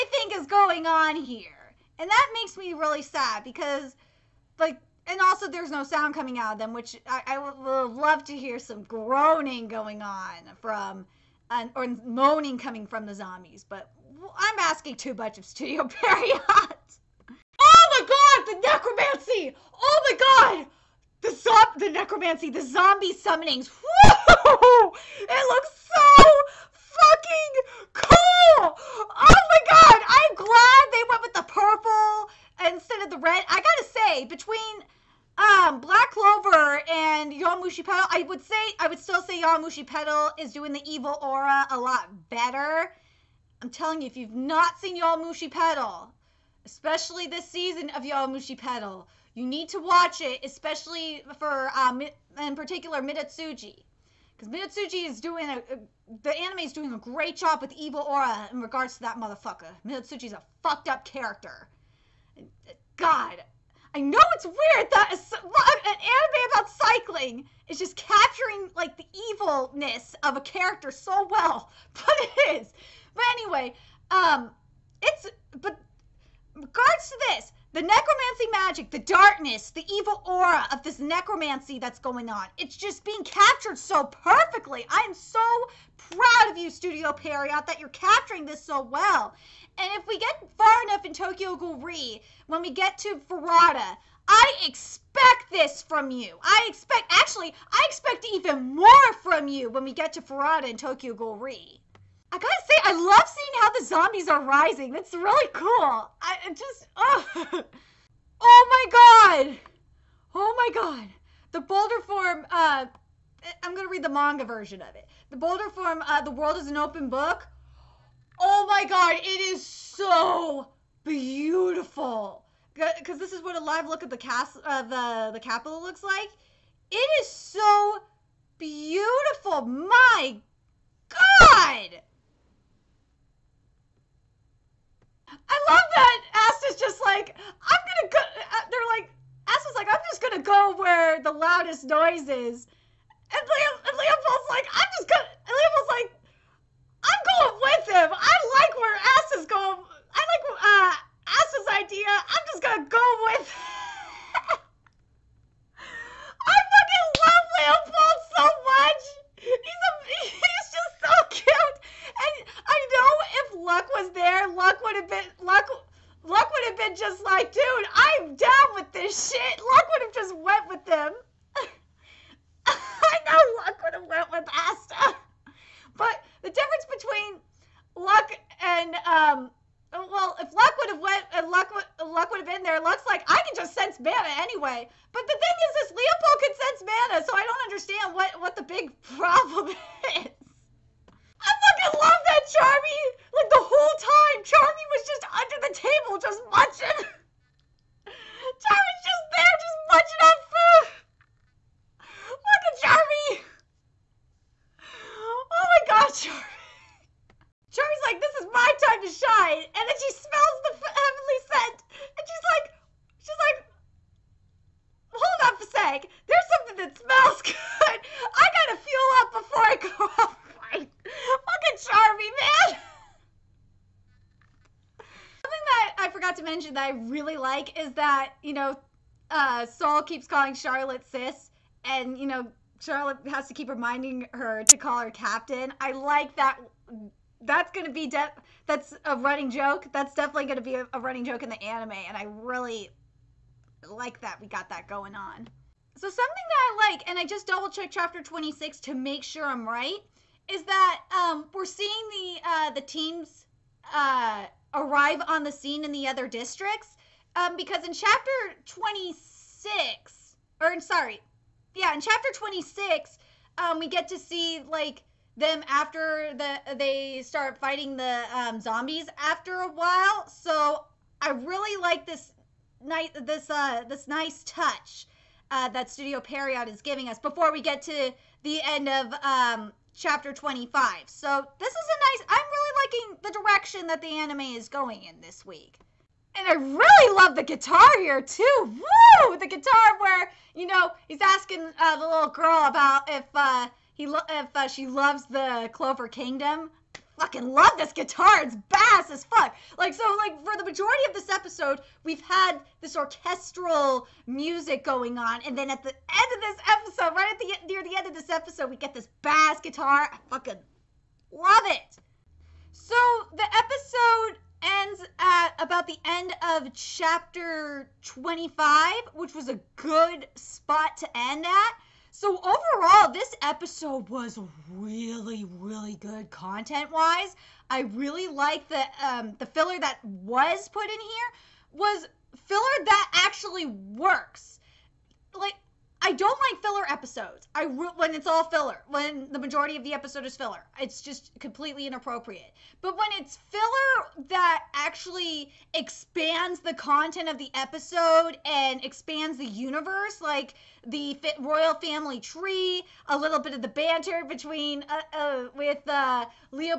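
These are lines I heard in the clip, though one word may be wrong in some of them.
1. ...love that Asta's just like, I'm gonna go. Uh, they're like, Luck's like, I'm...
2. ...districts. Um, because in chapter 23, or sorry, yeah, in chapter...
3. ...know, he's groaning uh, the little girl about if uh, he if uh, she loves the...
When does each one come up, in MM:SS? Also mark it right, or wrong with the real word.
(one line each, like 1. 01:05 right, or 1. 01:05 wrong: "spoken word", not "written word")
1. 02:15 wrong: "Asta", not "Luck"
2. 04:16 wrong: "26", not "23"
3. 04:50 wrong: "asking", not "groaning".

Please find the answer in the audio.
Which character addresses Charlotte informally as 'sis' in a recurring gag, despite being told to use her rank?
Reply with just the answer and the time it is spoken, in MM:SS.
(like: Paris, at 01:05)
Sol, at 03:49.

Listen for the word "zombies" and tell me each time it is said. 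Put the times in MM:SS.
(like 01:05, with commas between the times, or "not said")
00:13, 00:22, 01:43, 04:28.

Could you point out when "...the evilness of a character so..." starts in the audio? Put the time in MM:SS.
01:08.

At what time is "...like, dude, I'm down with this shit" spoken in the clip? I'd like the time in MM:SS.
02:47.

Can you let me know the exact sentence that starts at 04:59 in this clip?
Like, so, like, for the majority of this episode, we've had this orchestral music going on.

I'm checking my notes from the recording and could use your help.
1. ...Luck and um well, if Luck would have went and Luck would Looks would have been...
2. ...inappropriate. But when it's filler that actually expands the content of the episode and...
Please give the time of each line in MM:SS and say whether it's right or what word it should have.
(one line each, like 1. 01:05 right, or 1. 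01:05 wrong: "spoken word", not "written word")
1. 02:57 wrong: "Luck", not "Looks"
2. 05:41 right.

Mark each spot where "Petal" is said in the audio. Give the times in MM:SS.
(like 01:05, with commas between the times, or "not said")
00:48.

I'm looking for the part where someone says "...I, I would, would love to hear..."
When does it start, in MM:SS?
00:07.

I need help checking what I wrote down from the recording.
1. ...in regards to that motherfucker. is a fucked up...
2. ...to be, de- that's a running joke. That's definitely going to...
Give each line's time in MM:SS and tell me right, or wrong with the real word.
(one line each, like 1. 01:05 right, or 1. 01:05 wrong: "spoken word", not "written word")
1. 00:58 right
2. 03:57 right.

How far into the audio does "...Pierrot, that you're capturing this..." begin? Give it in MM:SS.
01:27.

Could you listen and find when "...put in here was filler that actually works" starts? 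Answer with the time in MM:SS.
05:30.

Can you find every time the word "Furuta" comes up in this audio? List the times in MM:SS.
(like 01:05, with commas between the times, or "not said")
01:33, 01:40.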